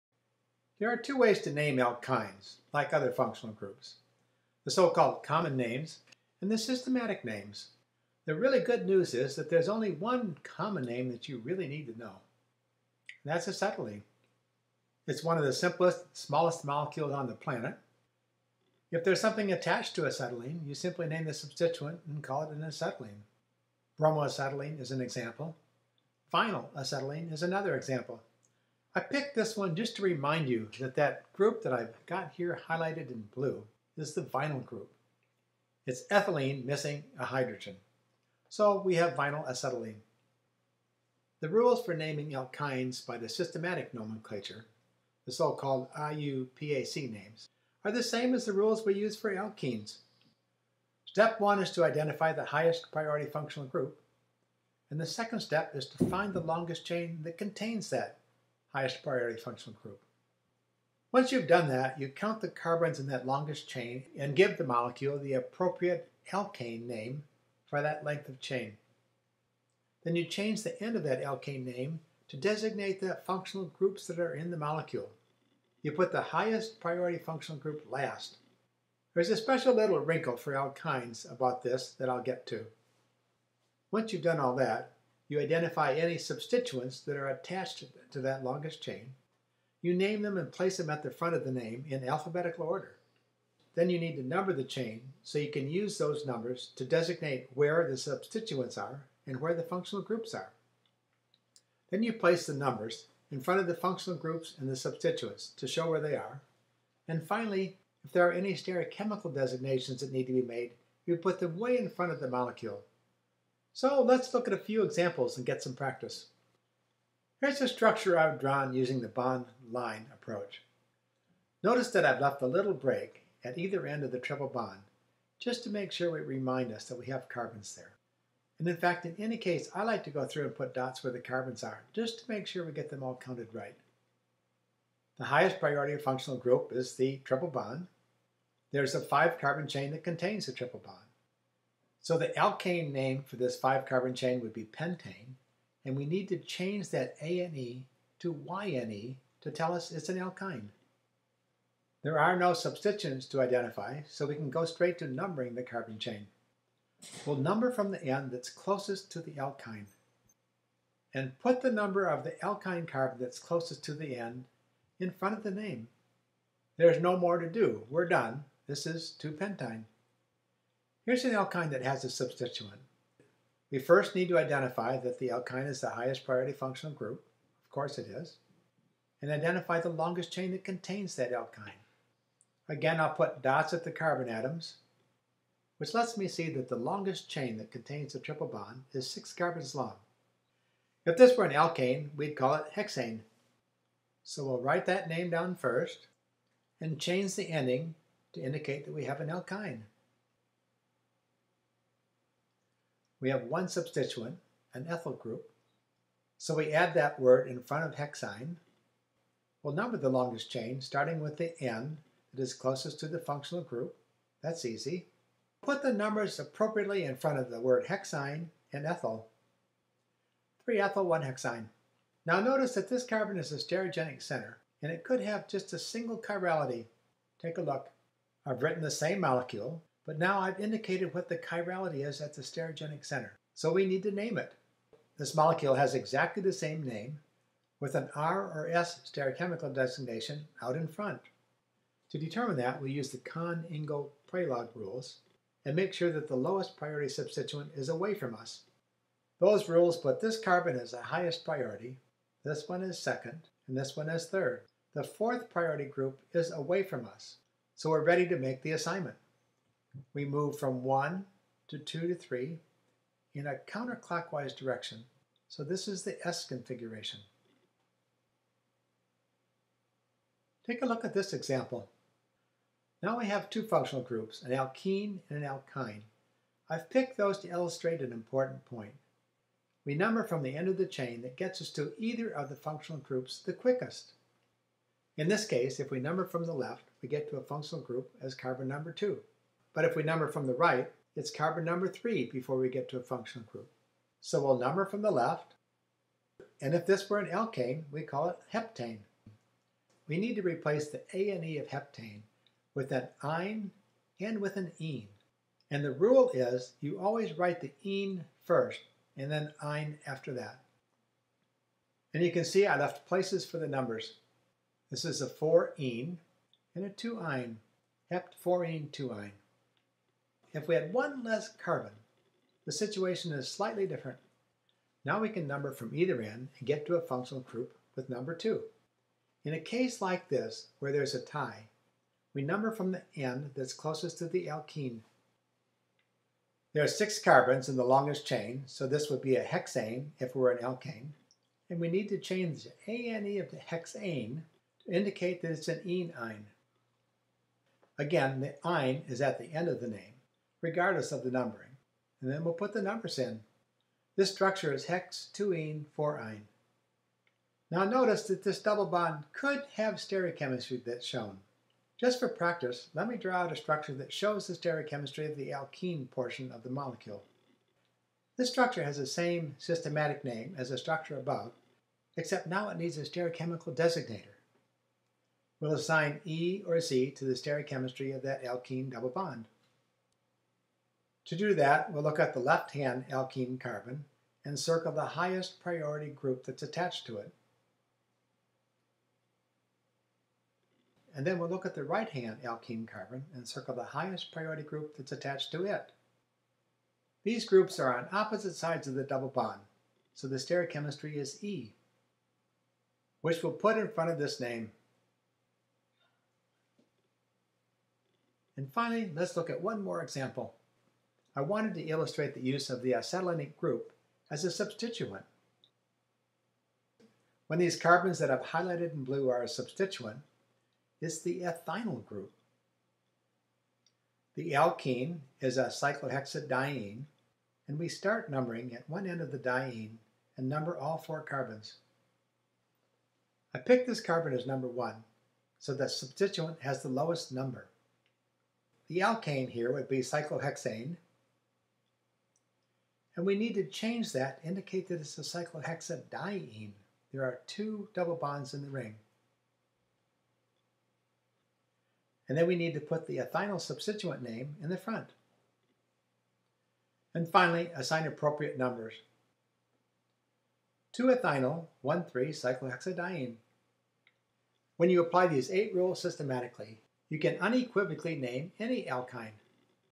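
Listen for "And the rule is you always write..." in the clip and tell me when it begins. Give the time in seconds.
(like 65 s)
305 s.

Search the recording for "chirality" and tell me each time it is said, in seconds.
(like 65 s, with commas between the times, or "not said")
226 s, 231 s.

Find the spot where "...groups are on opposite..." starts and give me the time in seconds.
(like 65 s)
397 s.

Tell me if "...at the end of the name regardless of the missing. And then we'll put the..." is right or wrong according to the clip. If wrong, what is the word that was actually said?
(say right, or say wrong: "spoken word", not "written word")
wrong: "numbering", not "missing".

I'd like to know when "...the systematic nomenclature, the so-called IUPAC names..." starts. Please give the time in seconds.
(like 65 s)
43 s.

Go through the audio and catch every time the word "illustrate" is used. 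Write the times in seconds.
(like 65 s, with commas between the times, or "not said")
277 s, 411 s.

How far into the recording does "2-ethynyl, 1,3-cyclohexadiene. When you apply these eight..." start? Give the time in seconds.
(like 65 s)
460 s.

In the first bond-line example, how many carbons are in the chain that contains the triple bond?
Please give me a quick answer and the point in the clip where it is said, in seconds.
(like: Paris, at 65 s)
5, at 139 s.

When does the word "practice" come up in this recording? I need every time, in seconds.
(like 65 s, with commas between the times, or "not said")
115 s, 362 s.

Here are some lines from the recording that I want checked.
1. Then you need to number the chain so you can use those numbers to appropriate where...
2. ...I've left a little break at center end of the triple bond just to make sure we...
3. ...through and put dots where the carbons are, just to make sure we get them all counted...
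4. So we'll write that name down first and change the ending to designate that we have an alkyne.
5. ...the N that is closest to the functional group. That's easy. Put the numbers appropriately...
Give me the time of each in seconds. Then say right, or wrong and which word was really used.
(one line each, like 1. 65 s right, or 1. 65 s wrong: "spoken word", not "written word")
1. 93 s wrong: "designate", not "appropriate"
2. 122 s wrong: "either", not "center"
3. 130 s right
4. 194 s wrong: "indicate", not "designate"
5. 211 s right.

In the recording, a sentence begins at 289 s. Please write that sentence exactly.
But if we number from the right, it's carbon number 3 before we get to a functional group.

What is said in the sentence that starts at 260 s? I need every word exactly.
We move from 1 to 2 to 3 in a counterclockwise direction.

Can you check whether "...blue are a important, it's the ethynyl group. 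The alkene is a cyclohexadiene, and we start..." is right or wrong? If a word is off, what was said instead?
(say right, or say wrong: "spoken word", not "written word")
wrong: "substituent", not "important".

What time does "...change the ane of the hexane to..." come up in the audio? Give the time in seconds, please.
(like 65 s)
342 s.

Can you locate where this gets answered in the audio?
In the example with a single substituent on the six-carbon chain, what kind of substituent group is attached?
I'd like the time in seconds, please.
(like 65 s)
204 s.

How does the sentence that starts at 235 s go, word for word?
This molecule has exactly the same name, with an R or S stereochemical designation out in front.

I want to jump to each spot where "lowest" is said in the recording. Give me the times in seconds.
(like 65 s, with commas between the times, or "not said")
246 s, 436 s.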